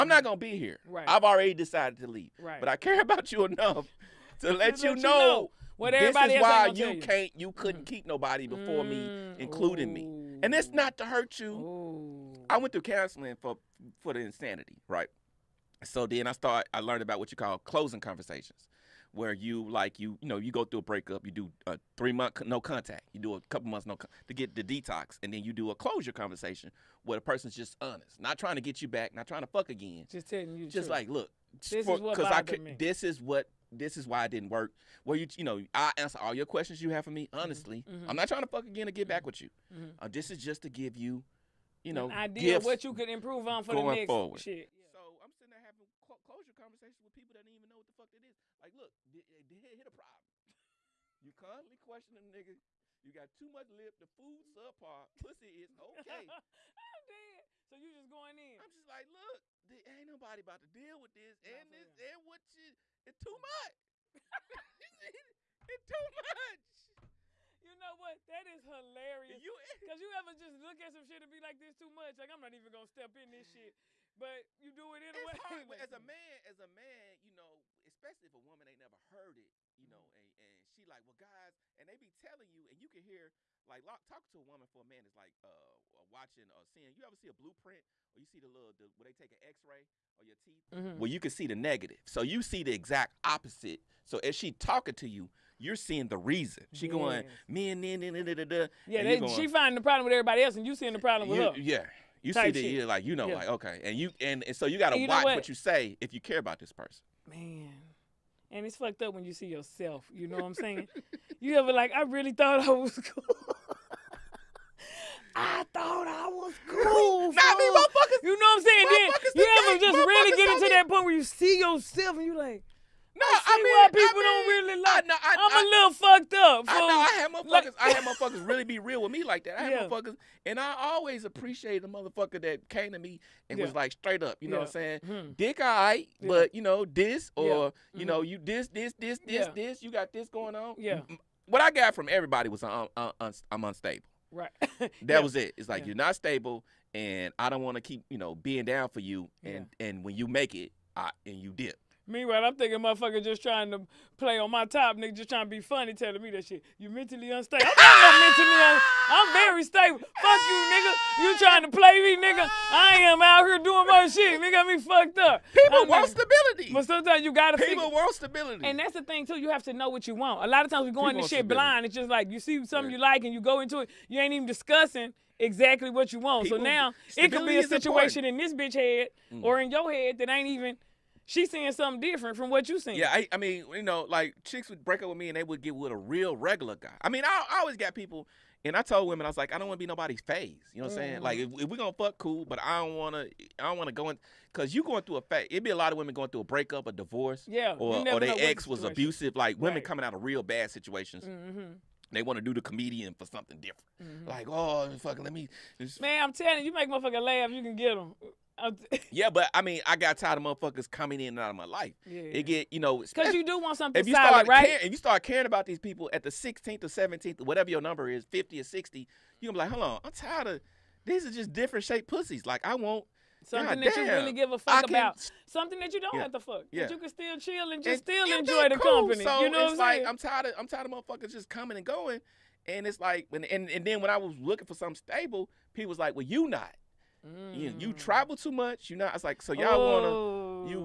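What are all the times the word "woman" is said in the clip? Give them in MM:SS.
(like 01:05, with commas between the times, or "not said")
01:18, 01:24.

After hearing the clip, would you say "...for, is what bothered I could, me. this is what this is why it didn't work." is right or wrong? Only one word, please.
right.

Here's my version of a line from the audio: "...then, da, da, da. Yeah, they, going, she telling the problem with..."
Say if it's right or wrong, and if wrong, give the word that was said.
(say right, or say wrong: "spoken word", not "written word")
wrong: "finding", not "telling".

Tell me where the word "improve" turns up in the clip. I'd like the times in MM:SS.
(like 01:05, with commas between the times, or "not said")
00:43.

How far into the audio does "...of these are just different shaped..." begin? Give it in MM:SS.
03:40.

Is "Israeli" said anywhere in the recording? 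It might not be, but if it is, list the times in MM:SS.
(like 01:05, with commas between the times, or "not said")
not said.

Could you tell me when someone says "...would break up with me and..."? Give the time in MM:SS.
03:04.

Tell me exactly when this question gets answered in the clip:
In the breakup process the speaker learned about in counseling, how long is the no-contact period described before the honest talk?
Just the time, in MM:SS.
00:21.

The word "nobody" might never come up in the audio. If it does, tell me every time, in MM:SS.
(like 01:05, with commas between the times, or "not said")
00:08, 01:00, 03:09.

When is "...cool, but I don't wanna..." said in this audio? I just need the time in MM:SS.
03:12.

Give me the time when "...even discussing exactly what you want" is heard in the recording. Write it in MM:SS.
02:54.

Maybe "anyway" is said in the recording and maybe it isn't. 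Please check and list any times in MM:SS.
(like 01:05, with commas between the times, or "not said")
01:15.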